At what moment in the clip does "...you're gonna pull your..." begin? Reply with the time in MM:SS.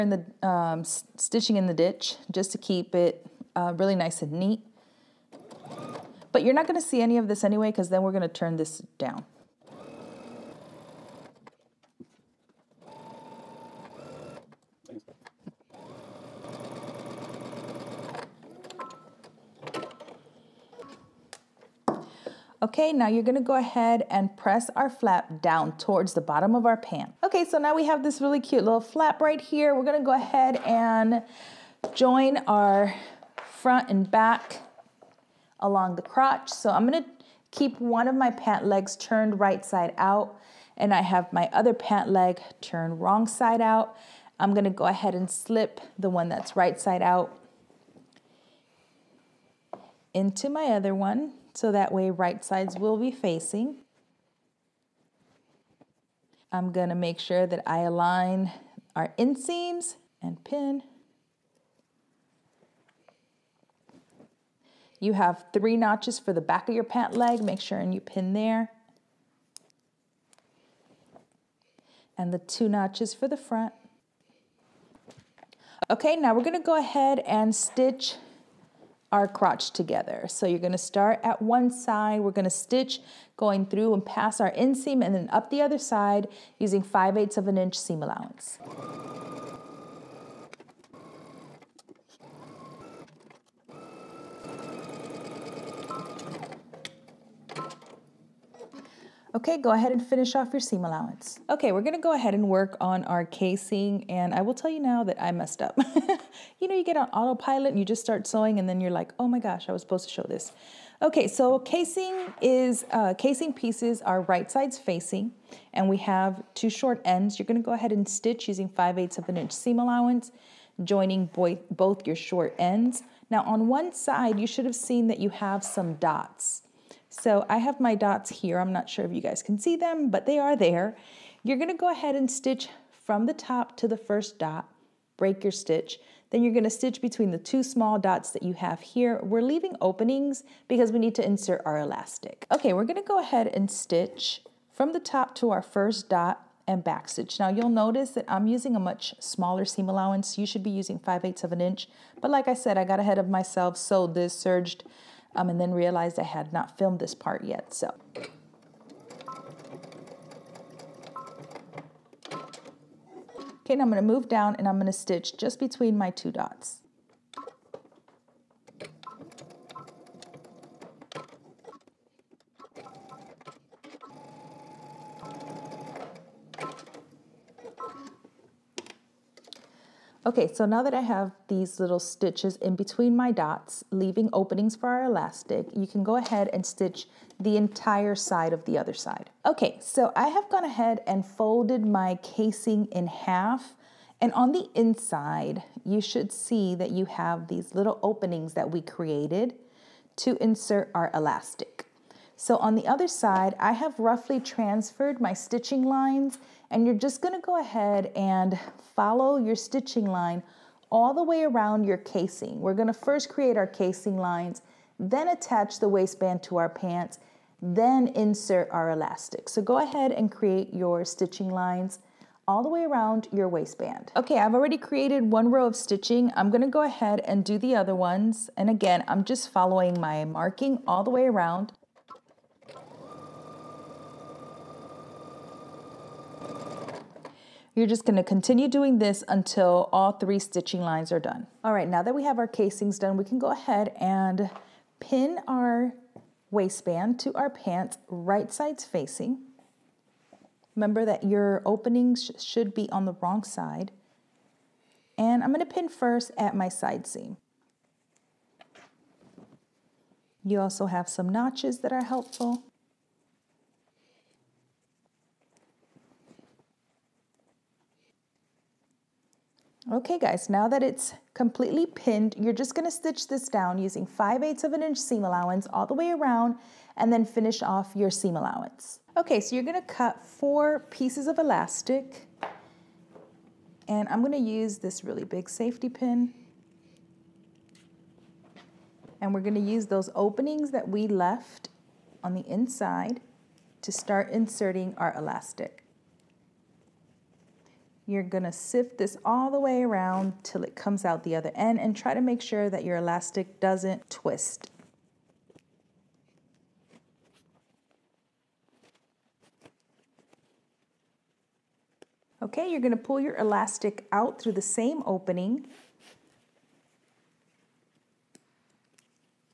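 05:12.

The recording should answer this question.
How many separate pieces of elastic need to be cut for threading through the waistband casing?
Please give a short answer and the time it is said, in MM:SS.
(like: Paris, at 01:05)
4, at 04:40.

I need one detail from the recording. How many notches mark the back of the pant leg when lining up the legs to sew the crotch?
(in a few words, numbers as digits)
3.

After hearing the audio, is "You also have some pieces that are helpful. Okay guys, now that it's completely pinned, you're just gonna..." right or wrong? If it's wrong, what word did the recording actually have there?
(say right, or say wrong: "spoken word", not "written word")
wrong: "notches", not "pieces".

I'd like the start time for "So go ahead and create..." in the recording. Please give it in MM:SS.
03:39.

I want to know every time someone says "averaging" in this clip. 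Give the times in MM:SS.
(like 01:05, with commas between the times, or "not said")
not said.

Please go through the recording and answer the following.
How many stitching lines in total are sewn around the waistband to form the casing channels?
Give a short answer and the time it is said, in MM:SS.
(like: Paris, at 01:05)
3, at 04:00.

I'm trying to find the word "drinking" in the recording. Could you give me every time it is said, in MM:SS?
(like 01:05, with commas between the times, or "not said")
not said.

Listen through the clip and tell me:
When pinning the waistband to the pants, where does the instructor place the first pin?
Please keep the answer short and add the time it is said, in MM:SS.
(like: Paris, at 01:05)
Side seam, at 04:16.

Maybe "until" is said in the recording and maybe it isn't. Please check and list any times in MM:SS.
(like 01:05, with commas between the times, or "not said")
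03:59.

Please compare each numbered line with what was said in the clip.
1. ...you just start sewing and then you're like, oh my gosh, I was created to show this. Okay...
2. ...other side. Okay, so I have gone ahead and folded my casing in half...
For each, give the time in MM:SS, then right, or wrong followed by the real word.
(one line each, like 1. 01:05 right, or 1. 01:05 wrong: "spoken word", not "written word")
1. 01:47 wrong: "supposed", not "created"
2. 03:08 right.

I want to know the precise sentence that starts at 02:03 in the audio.
Now on one side, you should have seen that you have some dots.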